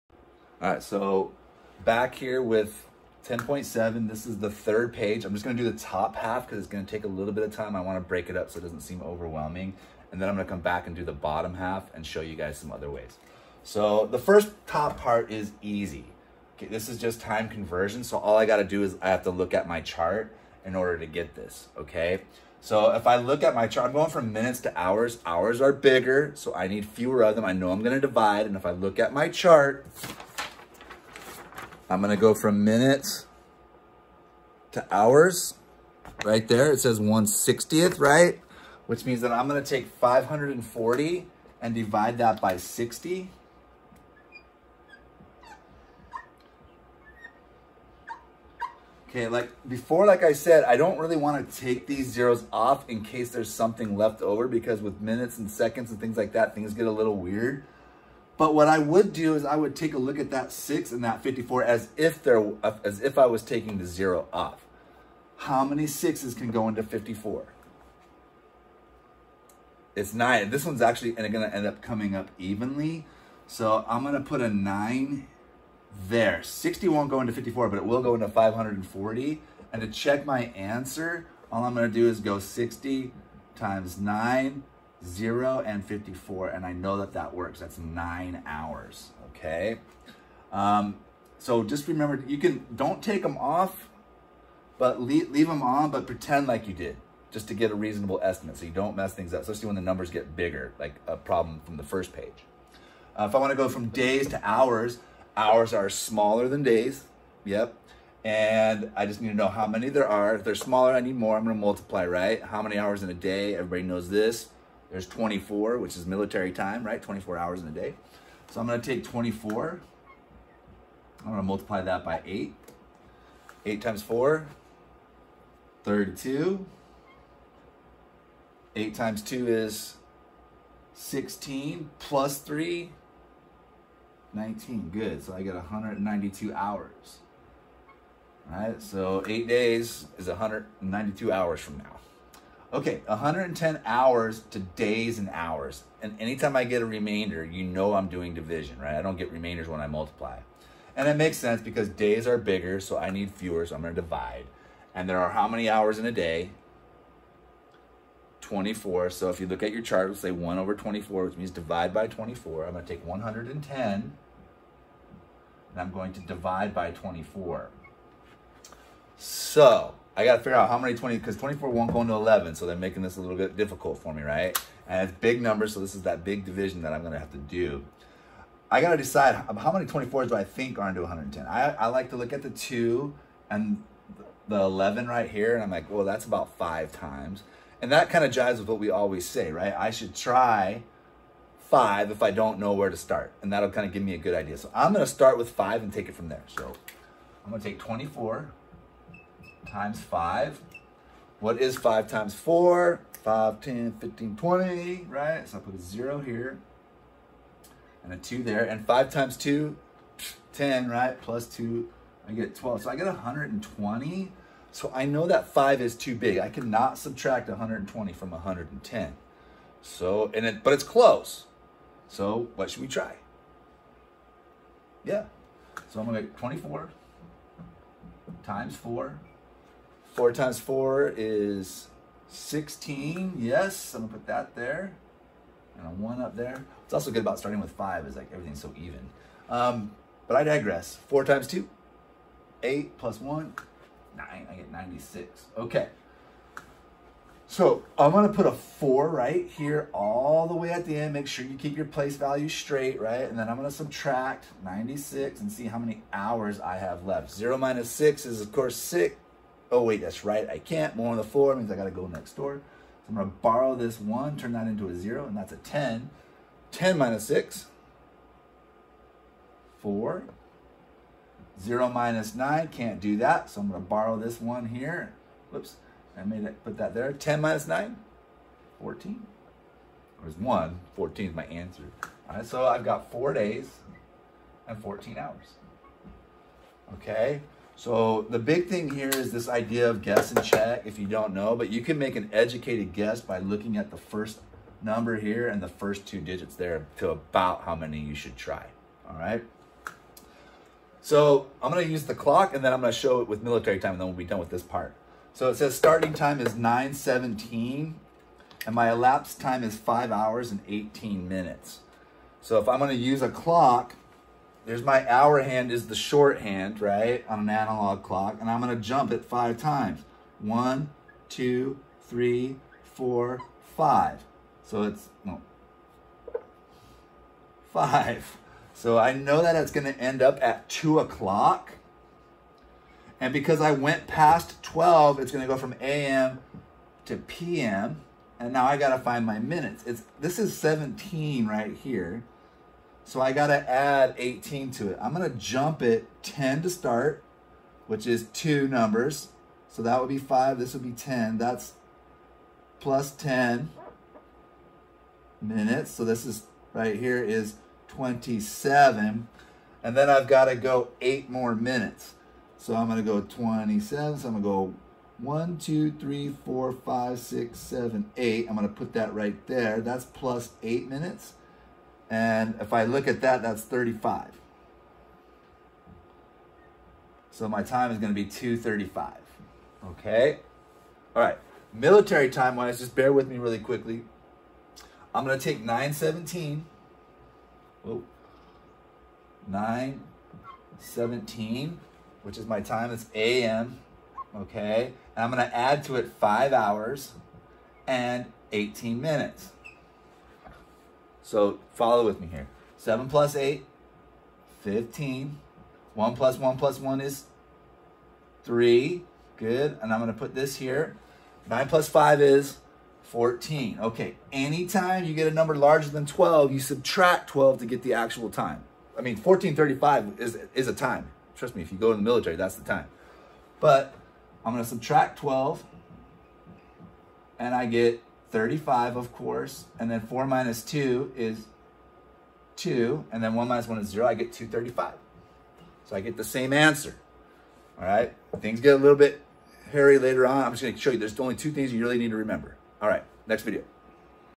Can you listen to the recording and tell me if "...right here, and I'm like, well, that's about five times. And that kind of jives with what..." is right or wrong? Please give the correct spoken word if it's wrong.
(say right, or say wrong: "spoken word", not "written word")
right.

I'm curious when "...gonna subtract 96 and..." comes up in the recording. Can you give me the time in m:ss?
4:13.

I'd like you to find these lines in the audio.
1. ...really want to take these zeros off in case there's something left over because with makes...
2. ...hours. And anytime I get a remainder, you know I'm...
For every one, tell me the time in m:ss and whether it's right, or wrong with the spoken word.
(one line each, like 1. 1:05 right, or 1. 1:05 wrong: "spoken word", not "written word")
1. 0:50 wrong: "minutes", not "makes"
2. 2:25 right.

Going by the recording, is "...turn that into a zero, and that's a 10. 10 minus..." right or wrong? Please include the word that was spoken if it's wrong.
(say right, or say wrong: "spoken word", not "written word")
right.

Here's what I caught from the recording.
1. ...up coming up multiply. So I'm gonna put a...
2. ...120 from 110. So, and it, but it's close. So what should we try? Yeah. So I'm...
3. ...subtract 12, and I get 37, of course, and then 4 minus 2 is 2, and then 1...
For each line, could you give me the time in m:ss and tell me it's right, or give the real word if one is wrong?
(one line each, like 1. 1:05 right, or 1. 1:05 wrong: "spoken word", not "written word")
1. 1:11 wrong: "evenly", not "multiply"
2. 3:37 right
3. 7:04 wrong: "35", not "37".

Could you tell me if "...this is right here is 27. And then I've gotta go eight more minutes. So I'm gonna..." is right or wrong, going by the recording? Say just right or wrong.
right.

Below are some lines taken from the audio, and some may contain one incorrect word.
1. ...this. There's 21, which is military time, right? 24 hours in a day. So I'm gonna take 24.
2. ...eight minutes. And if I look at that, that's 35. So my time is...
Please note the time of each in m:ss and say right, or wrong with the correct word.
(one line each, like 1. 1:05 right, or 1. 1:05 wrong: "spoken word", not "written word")
1. 1:54 wrong: "24", not "21"
2. 6:10 right.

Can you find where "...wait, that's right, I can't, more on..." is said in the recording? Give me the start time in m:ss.
4:19.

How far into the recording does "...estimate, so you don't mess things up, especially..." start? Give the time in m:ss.
1:38.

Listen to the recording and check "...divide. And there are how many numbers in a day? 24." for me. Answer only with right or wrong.
wrong.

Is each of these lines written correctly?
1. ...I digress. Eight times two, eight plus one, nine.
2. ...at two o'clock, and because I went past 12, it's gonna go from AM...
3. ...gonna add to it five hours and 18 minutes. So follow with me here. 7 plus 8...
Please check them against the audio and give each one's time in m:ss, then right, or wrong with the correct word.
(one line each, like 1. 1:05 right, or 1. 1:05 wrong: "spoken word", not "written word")
1. 4:00 wrong: "Four", not "Eight"
2. 5:30 right
3. 6:35 right.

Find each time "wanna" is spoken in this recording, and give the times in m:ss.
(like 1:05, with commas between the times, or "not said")
0:07, 1:43.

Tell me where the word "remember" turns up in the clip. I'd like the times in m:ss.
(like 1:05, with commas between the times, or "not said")
1:31, 7:22.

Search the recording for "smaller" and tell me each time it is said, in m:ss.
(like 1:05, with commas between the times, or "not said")
1:45, 1:50.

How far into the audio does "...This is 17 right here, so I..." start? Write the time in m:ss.
5:40.